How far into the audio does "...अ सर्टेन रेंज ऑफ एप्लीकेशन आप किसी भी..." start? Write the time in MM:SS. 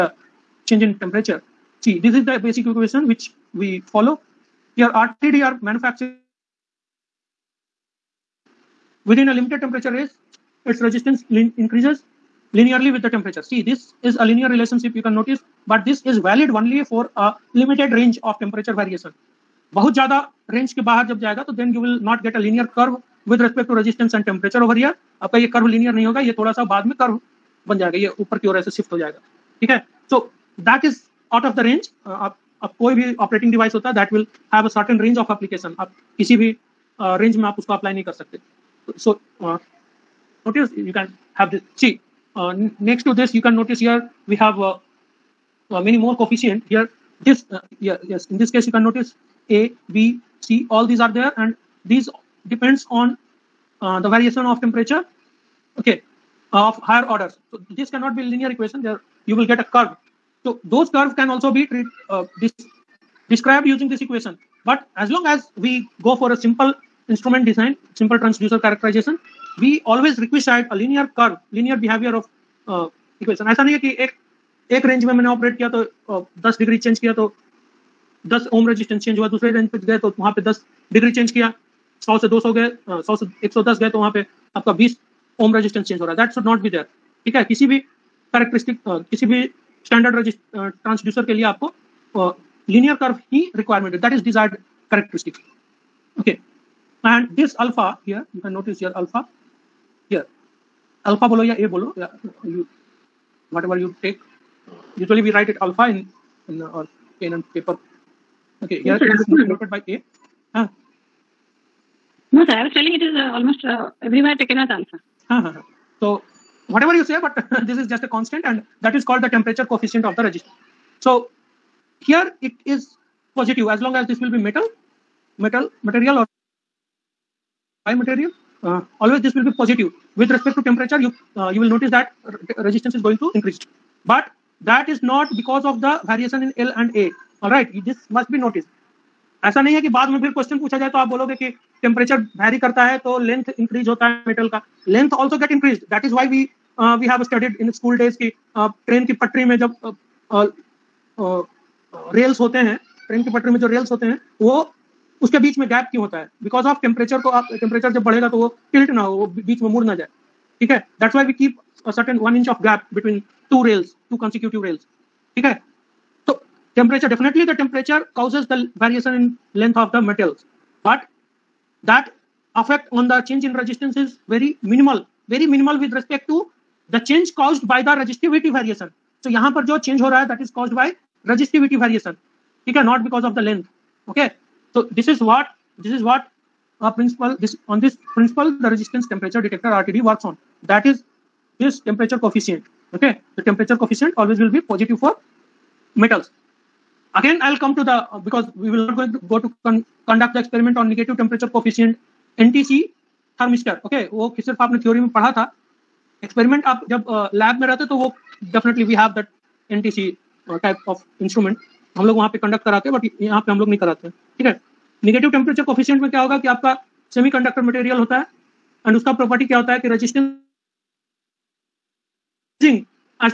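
00:34.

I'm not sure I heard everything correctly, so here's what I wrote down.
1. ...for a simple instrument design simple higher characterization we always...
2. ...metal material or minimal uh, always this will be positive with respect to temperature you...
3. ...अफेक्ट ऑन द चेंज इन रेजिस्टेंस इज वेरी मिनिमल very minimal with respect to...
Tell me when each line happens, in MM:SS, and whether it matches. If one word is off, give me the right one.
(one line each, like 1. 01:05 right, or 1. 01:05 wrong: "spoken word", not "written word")
1. 01:06 wrong: "transducer", not "higher"
2. 02:05 wrong: "material", not "minimal"
3. 02:52 right.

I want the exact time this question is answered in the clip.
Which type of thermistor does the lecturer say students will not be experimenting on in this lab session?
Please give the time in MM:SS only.
03:22.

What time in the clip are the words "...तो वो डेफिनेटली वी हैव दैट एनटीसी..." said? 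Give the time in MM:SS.
03:27.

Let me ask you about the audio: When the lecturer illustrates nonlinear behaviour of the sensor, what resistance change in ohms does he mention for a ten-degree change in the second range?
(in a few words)
20 ohms.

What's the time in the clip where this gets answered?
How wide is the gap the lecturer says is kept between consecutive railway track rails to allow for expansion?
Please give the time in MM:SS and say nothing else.
02:42.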